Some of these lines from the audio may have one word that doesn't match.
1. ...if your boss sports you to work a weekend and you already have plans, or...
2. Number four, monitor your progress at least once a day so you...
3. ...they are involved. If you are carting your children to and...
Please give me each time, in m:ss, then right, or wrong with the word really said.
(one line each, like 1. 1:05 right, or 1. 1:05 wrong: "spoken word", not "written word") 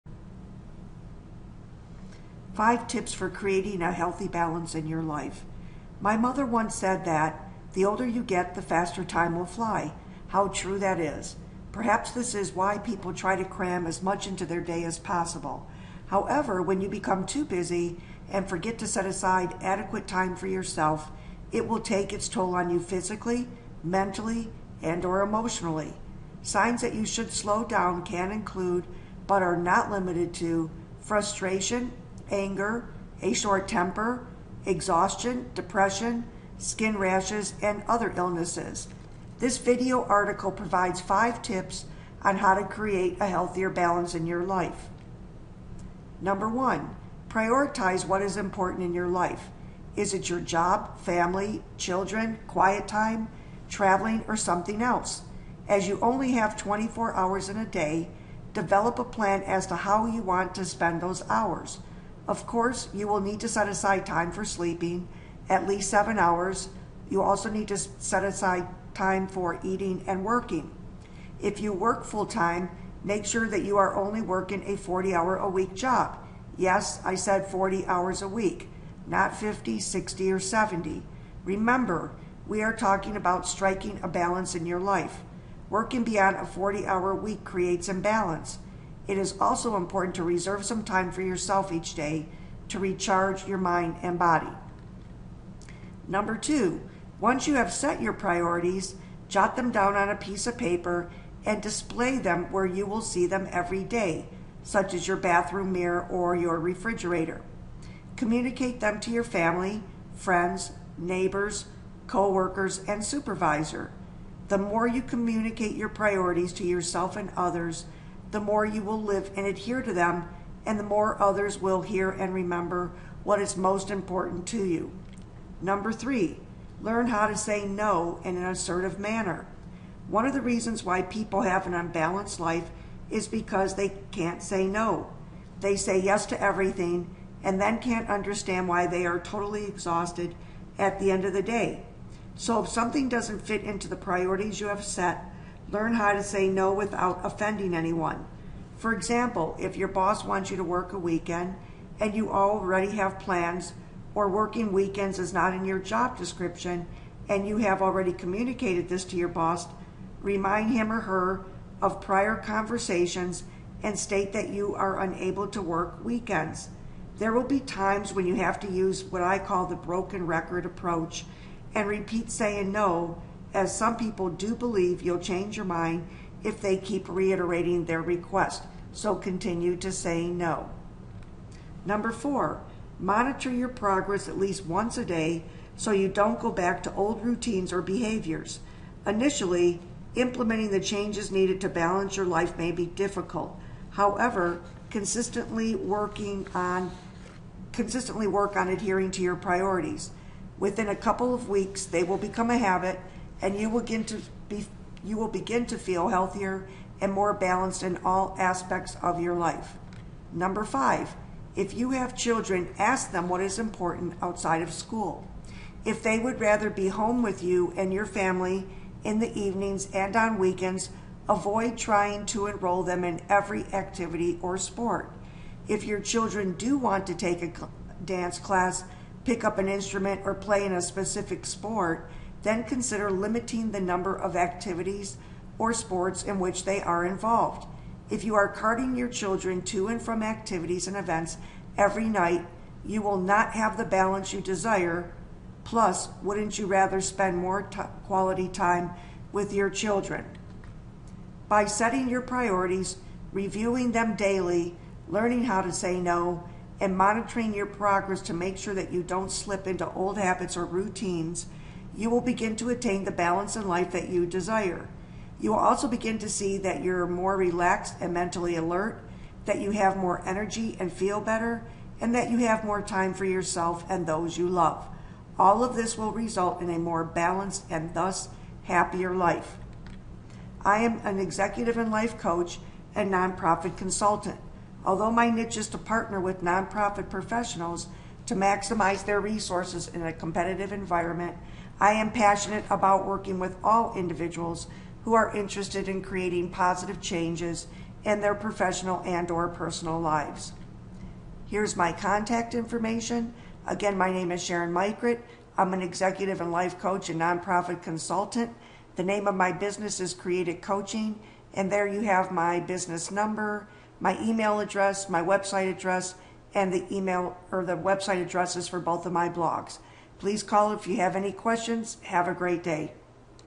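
1. 2:29 wrong: "wants", not "sports"
2. 3:01 right
3. 3:56 right.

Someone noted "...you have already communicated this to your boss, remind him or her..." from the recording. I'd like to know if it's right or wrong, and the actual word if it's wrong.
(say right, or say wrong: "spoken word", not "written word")
right.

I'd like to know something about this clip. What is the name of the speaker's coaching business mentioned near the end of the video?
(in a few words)
Create It Coaching.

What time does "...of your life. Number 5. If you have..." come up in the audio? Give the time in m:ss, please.
3:29.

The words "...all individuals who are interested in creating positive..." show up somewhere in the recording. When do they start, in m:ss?
4:53.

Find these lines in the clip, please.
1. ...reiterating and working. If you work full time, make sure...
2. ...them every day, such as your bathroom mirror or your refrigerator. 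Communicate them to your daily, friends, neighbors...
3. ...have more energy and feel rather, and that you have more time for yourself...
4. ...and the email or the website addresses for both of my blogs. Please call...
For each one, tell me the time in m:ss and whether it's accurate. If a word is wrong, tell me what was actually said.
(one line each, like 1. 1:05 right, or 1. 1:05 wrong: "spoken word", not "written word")
1. 1:09 wrong: "eating", not "reiterating"
2. 1:43 wrong: "family", not "daily"
3. 4:29 wrong: "better", not "rather"
4. 5:16 right.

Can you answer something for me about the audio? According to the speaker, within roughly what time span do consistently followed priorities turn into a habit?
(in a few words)
a couple of weeks.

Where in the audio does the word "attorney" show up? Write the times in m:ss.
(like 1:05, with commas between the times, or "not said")
not said.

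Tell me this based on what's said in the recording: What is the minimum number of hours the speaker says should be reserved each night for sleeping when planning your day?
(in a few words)
7.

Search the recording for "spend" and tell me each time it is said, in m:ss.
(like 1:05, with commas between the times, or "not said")
1:00, 4:06.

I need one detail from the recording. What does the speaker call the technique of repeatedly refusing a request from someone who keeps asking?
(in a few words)
broken record approach.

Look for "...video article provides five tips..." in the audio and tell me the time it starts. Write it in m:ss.
0:39.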